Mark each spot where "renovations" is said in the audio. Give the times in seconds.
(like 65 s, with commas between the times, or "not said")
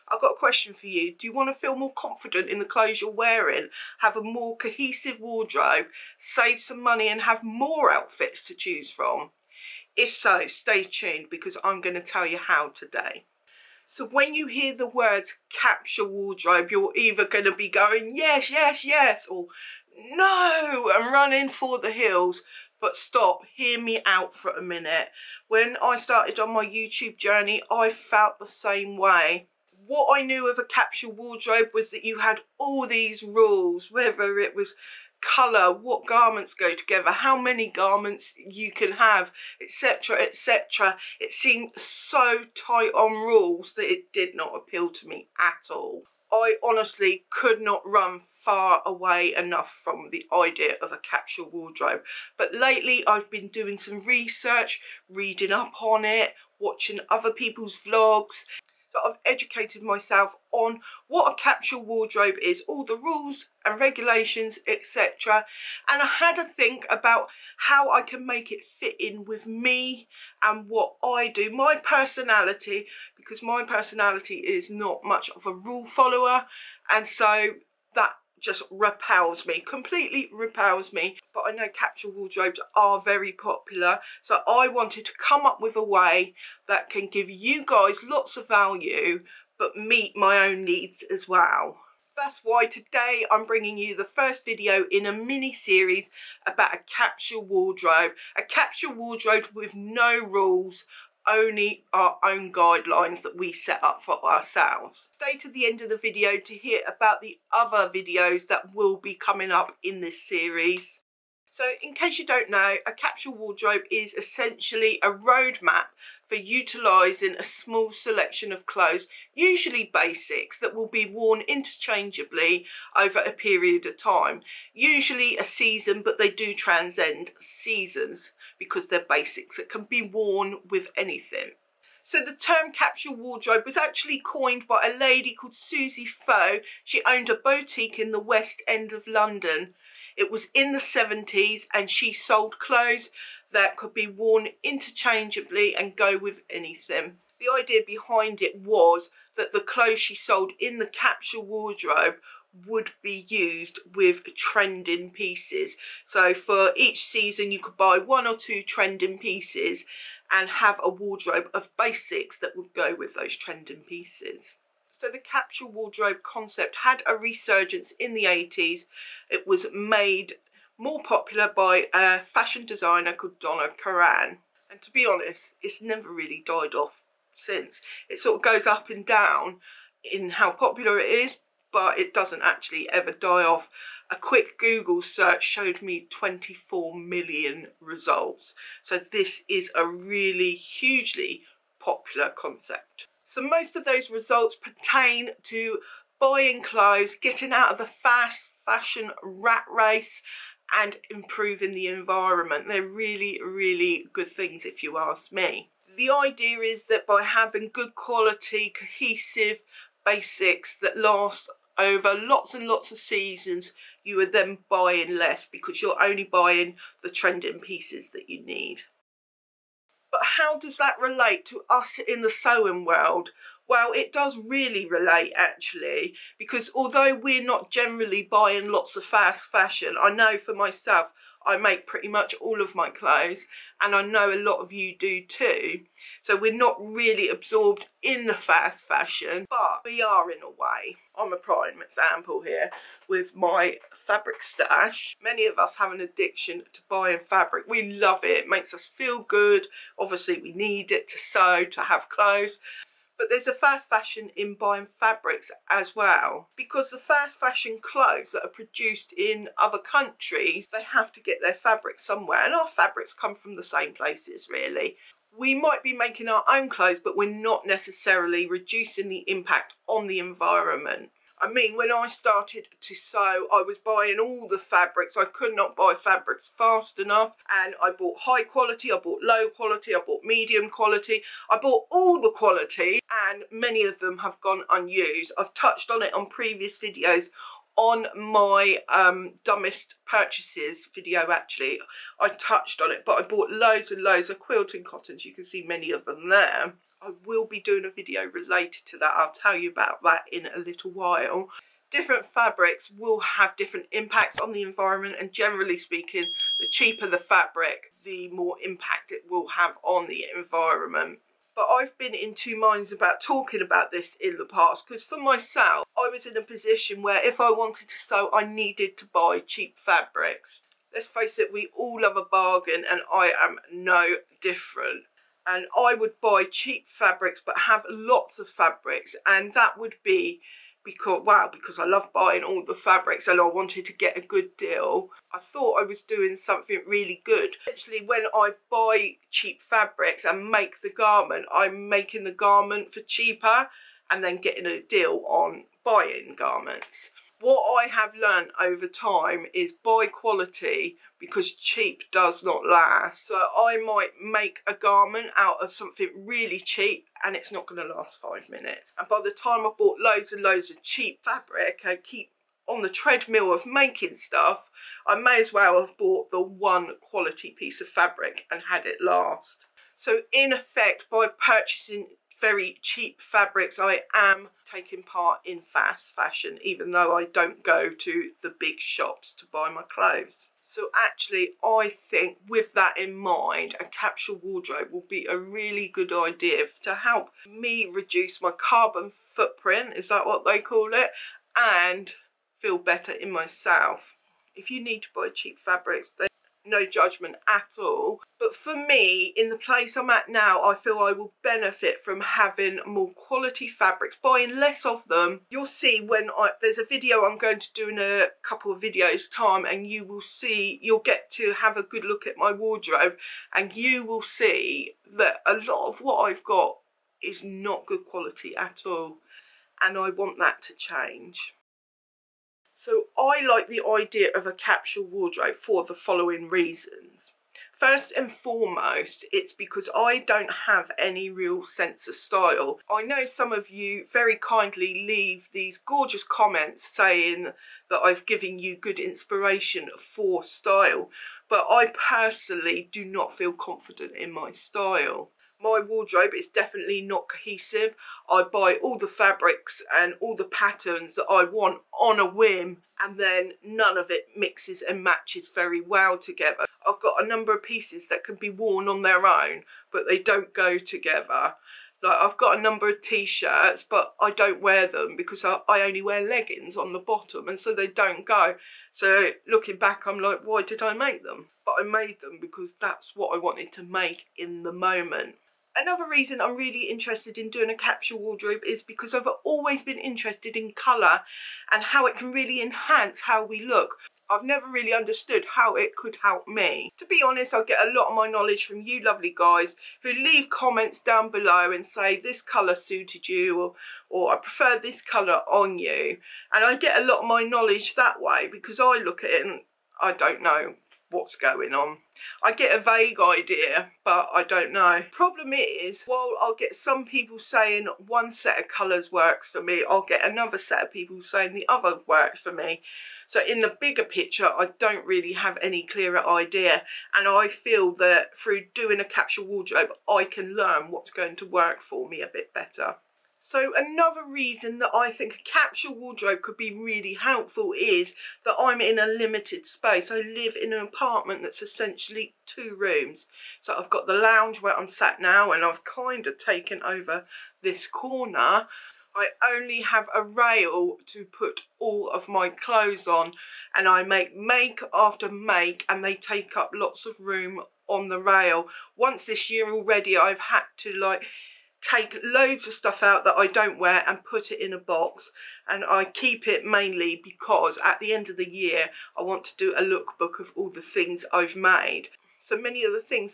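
not said.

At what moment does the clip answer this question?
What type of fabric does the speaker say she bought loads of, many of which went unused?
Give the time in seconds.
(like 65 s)
294 s.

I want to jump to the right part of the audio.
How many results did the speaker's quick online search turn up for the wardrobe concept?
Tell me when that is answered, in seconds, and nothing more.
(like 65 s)
186 s.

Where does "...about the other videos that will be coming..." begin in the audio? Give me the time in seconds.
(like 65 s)
106 s.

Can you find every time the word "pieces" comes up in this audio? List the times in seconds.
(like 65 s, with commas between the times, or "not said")
155 s, 159 s, 163 s, 217 s, 367 s, 457 s.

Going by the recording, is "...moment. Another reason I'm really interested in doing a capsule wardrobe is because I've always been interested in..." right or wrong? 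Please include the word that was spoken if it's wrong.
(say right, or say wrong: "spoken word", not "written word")
right.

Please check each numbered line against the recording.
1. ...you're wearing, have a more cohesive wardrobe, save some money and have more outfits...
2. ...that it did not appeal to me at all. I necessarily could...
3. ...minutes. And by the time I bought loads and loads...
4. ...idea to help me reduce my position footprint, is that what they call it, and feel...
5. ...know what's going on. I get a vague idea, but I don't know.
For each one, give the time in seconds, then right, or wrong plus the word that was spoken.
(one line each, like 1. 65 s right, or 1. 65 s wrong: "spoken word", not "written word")
1. 2 s right
2. 43 s wrong: "honestly", not "necessarily"
3. 358 s right
4. 386 s wrong: "carbon", not "position"
5. 500 s right.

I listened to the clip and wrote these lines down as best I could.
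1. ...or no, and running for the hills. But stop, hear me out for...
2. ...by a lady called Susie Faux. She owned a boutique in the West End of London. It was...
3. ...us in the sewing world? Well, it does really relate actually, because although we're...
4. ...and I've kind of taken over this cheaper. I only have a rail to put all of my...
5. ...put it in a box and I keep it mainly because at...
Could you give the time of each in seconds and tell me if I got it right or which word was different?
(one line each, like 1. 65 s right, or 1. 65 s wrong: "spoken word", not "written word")
1. 19 s right
2. 134 s right
3. 221 s right
4. 535 s wrong: "corner", not "cheaper"
5. 554 s right.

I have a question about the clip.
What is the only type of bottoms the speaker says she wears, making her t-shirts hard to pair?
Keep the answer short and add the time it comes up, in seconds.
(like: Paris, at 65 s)
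Leggings, at 466 s.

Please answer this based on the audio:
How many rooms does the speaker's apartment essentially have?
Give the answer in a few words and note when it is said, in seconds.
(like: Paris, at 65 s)
2, at 532 s.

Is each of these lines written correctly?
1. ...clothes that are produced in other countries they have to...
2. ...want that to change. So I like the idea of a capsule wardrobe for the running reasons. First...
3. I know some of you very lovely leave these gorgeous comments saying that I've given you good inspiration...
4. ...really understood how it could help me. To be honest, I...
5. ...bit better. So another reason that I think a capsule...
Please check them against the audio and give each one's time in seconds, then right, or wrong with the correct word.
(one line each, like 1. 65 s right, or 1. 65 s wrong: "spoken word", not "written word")
1. 257 s right
2. 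420 s wrong: "following", not "running"
3. 432 s wrong: "kindly", not "lovely"
4. 484 s right
5. 522 s right.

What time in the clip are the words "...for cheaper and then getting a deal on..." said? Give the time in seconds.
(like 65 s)
342 s.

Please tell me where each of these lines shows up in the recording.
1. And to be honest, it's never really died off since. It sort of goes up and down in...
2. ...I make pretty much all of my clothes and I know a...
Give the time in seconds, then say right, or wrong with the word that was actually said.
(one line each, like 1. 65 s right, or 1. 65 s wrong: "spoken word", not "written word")
1. 174 s right
2. 231 s right.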